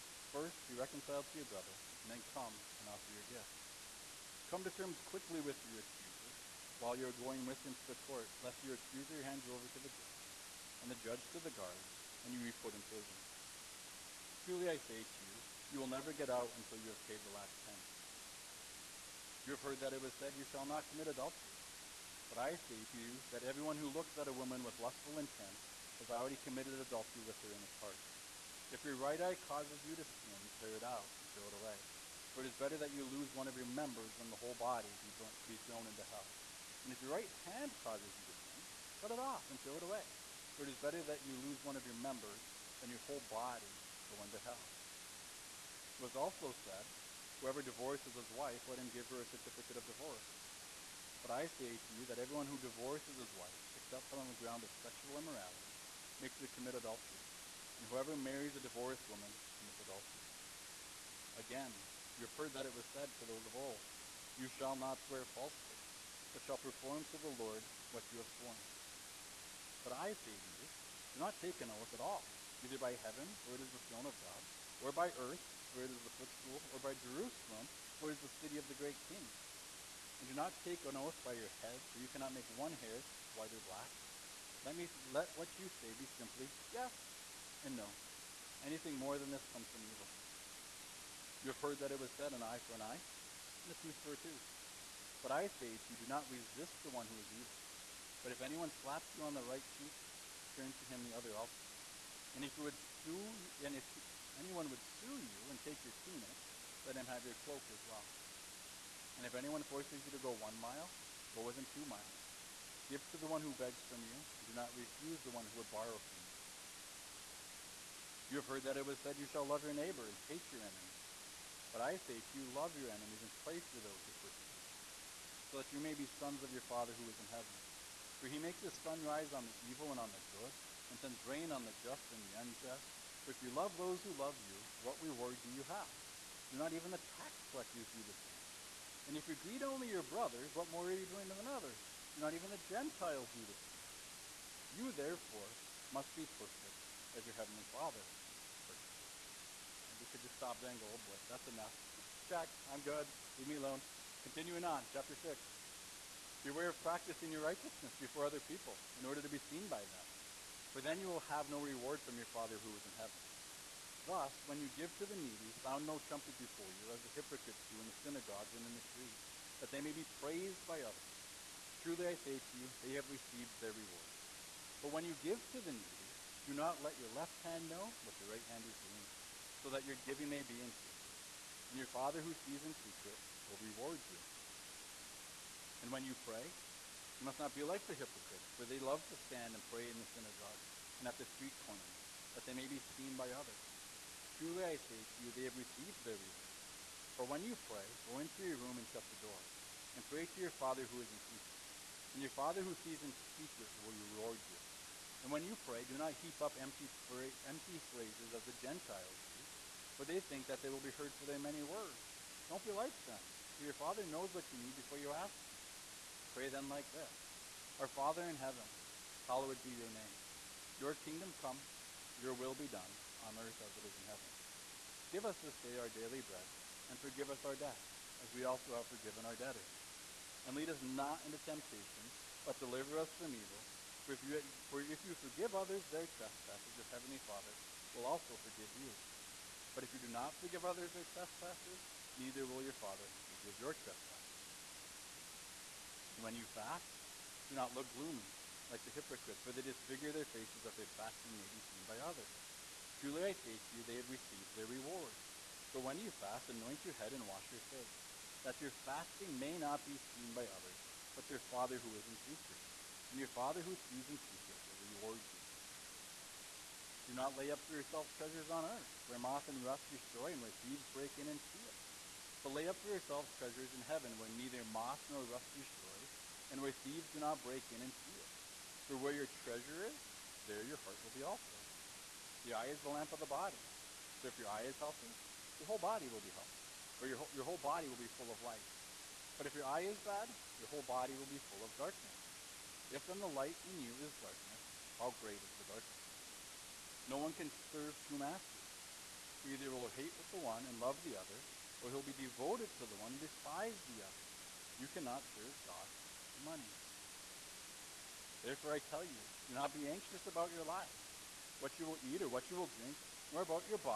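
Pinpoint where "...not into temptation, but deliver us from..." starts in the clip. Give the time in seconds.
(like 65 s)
230 s.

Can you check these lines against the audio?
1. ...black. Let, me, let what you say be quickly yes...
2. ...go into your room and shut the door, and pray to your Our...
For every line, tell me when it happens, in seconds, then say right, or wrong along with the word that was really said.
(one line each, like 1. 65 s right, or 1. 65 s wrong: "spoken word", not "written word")
1. 83 s wrong: "simply", not "quickly"
2. 198 s wrong: "Father", not "Our".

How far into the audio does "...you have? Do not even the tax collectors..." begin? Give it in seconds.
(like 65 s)
135 s.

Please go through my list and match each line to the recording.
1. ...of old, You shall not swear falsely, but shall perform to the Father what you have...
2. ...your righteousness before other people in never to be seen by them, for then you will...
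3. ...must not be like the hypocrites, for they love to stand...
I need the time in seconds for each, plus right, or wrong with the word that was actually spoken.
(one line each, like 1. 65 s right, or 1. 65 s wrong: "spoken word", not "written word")
1. 63 s wrong: "Lord", not "Father"
2. 157 s wrong: "order", not "never"
3. 187 s right.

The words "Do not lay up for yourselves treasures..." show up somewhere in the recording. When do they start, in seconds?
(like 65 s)
267 s.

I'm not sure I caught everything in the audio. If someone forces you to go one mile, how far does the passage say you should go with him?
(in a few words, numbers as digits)
2 miles.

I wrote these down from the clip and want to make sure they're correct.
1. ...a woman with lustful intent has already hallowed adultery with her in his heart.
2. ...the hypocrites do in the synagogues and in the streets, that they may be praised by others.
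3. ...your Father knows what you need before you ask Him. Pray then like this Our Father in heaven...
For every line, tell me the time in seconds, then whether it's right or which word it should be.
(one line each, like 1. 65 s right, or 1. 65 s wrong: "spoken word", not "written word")
1. 24 s wrong: "committed", not "hallowed"
2. 167 s right
3. 213 s right.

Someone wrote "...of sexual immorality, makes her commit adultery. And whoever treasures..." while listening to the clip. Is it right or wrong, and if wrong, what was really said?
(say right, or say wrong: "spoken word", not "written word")
wrong: "marries", not "treasures".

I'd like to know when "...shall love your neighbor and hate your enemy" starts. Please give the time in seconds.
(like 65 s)
119 s.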